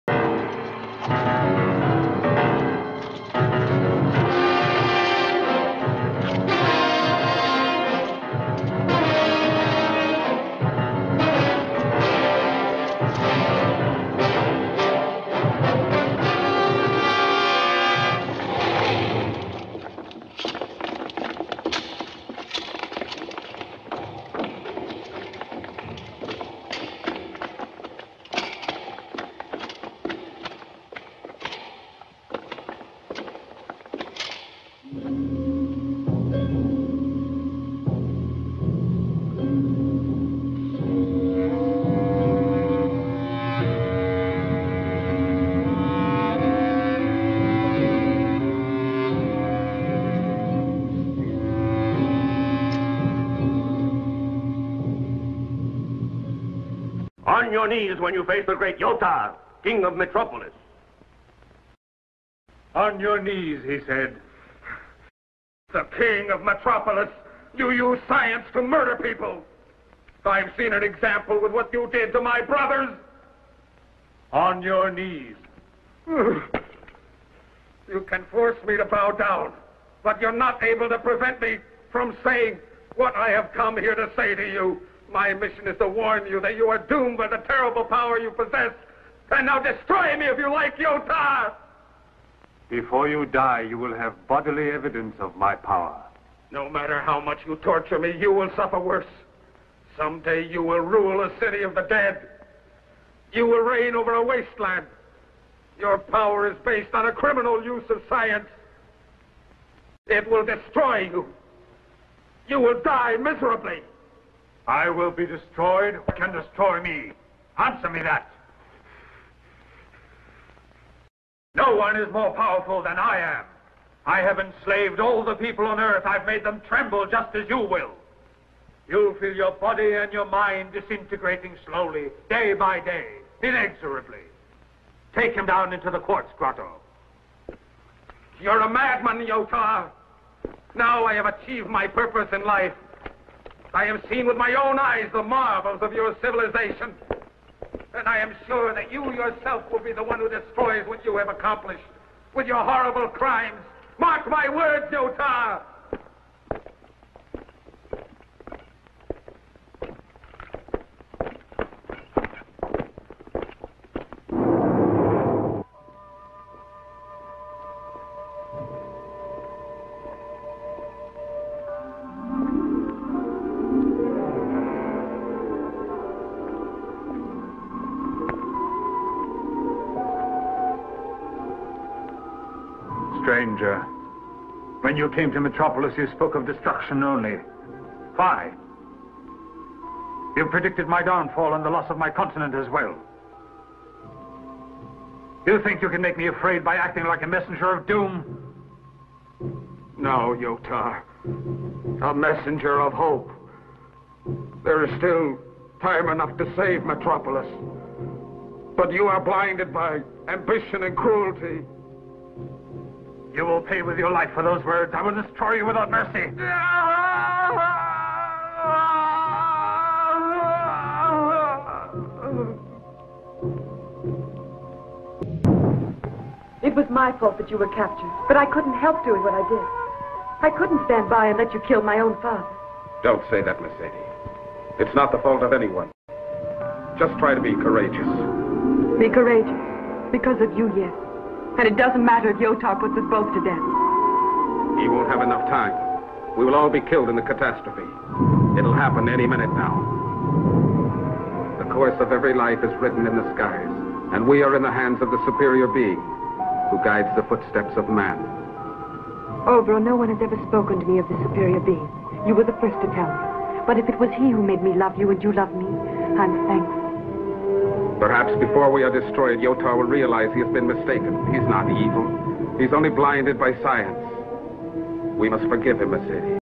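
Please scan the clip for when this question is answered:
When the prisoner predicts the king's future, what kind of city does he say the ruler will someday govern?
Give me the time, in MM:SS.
01:41.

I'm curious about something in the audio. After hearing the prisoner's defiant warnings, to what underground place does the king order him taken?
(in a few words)
The quartz grotto.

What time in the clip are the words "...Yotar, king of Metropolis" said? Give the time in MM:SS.
00:58.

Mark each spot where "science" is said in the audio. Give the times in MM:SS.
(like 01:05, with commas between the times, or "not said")
01:08, 01:48, 04:33.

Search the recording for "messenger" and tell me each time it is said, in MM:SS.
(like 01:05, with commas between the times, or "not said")
03:17, 03:22.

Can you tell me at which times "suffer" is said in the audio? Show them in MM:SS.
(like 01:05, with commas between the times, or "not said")
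01:38.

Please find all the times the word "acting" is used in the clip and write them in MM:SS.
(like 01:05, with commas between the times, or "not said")
03:16.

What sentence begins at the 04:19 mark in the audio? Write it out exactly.
Obro, no one has ever spoken to me of the superior being.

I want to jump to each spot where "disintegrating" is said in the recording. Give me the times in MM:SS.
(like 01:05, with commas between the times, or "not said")
02:10.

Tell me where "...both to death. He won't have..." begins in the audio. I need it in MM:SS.
04:03.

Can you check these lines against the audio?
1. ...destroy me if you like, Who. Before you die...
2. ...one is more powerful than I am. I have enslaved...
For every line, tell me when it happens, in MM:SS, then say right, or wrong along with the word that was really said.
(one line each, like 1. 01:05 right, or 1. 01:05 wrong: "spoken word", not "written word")
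1. 01:29 wrong: "Yota", not "Who"
2. 02:01 right.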